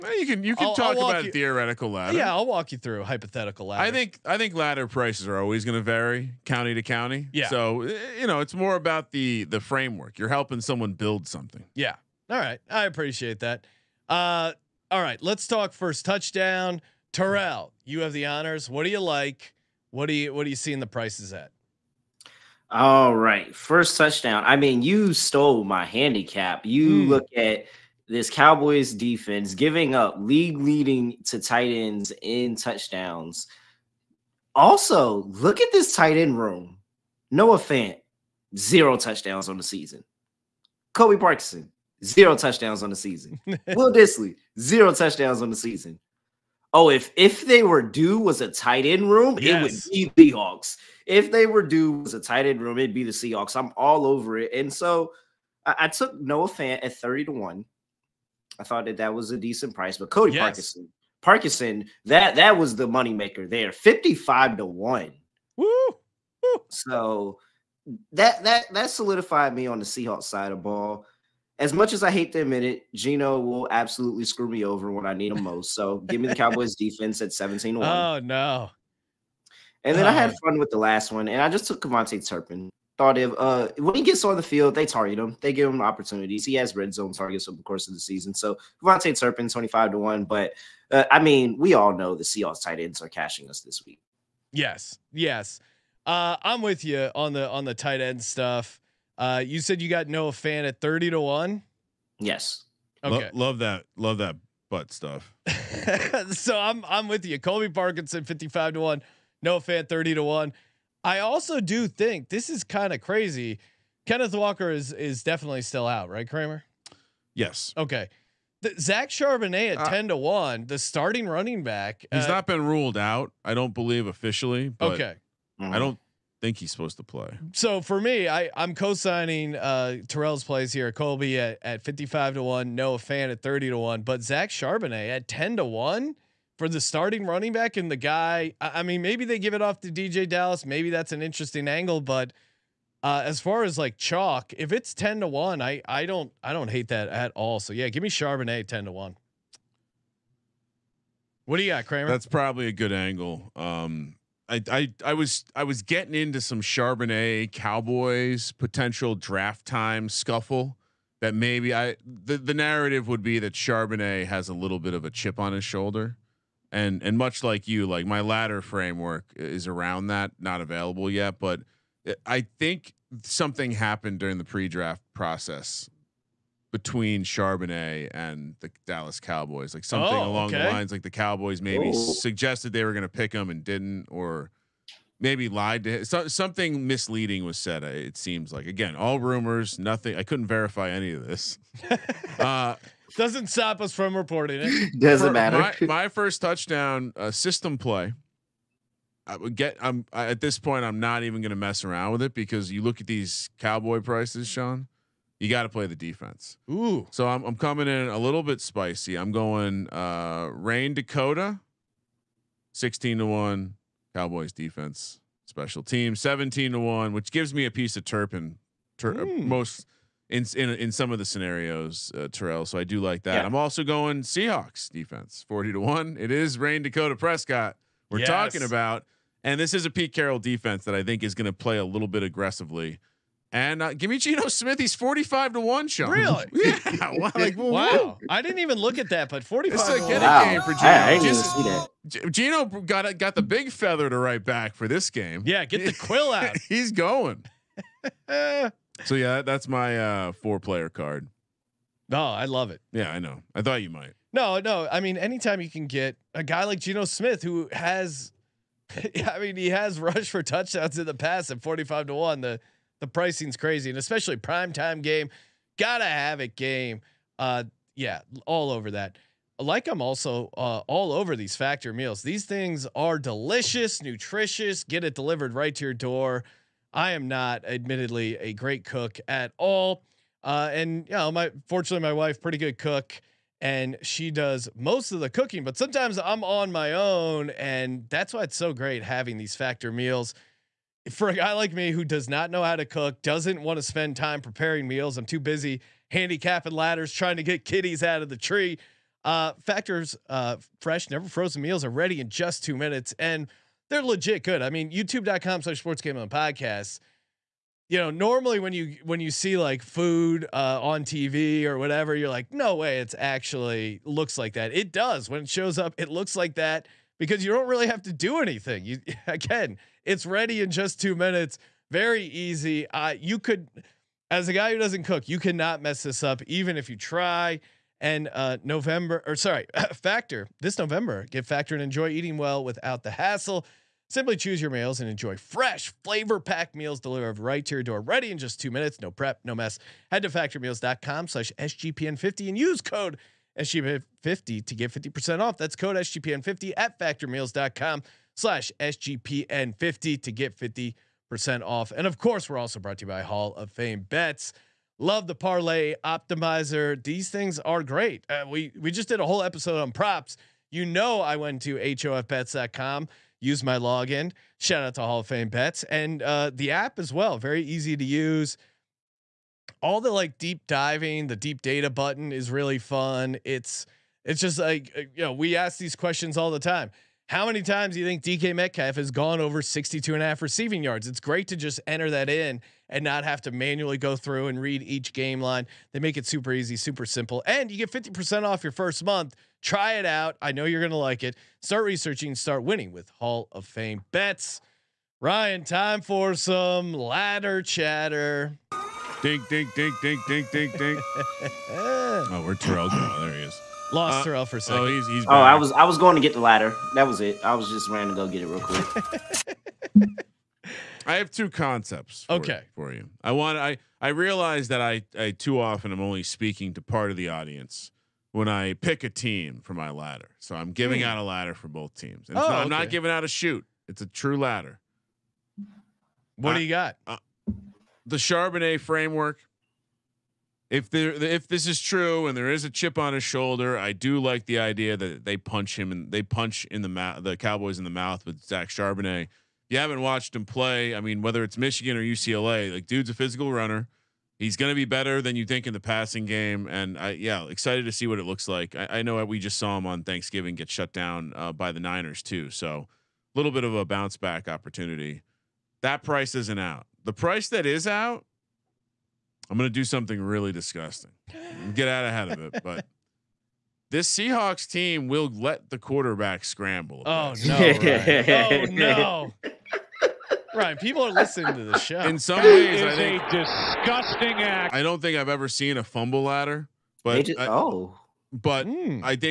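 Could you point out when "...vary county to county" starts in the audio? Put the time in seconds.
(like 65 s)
5 s.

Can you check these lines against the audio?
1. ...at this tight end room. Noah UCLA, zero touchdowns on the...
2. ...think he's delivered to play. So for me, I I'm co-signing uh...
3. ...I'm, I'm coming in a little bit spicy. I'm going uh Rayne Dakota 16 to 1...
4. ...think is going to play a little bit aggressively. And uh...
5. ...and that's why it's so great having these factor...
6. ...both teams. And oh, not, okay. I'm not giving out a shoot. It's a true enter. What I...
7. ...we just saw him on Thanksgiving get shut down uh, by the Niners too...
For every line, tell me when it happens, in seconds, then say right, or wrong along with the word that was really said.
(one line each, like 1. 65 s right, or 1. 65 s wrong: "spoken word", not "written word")
1. 35 s wrong: "Fant", not "UCLA"
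2. 126 s wrong: "supposed", not "delivered"
3. 207 s right
4. 231 s right
5. 287 s right
6. 421 s wrong: "ladder", not "enter"
7. 449 s right.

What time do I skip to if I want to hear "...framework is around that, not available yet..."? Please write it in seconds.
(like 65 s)
168 s.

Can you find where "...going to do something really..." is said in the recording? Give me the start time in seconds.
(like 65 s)
459 s.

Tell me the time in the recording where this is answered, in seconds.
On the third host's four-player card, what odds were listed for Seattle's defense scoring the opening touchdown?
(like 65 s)
225 s.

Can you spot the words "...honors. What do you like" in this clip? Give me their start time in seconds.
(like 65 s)
18 s.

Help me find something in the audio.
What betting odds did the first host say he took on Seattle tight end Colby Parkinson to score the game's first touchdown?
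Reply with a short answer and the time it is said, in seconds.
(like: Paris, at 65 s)
55 to 1, at 63 s.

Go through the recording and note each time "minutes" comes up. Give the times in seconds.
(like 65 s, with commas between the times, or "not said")
302 s, 321 s, 338 s.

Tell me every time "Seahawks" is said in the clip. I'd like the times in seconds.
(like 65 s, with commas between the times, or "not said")
53 s, 69 s, 92 s, 224 s, 464 s.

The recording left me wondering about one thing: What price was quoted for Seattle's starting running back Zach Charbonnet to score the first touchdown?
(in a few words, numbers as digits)
10 to 1.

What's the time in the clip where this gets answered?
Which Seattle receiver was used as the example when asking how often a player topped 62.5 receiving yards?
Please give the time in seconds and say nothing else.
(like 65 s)
378 s.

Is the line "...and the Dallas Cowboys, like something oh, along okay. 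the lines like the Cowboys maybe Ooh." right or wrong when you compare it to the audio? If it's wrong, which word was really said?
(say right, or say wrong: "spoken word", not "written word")
right.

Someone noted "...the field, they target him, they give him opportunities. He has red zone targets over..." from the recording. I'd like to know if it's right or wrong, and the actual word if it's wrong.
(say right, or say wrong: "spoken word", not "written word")
right.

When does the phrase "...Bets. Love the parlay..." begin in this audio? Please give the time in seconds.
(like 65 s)
354 s.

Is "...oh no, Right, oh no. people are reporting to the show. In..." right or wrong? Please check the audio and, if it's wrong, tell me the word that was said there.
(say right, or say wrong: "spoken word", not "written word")
wrong: "listening", not "reporting".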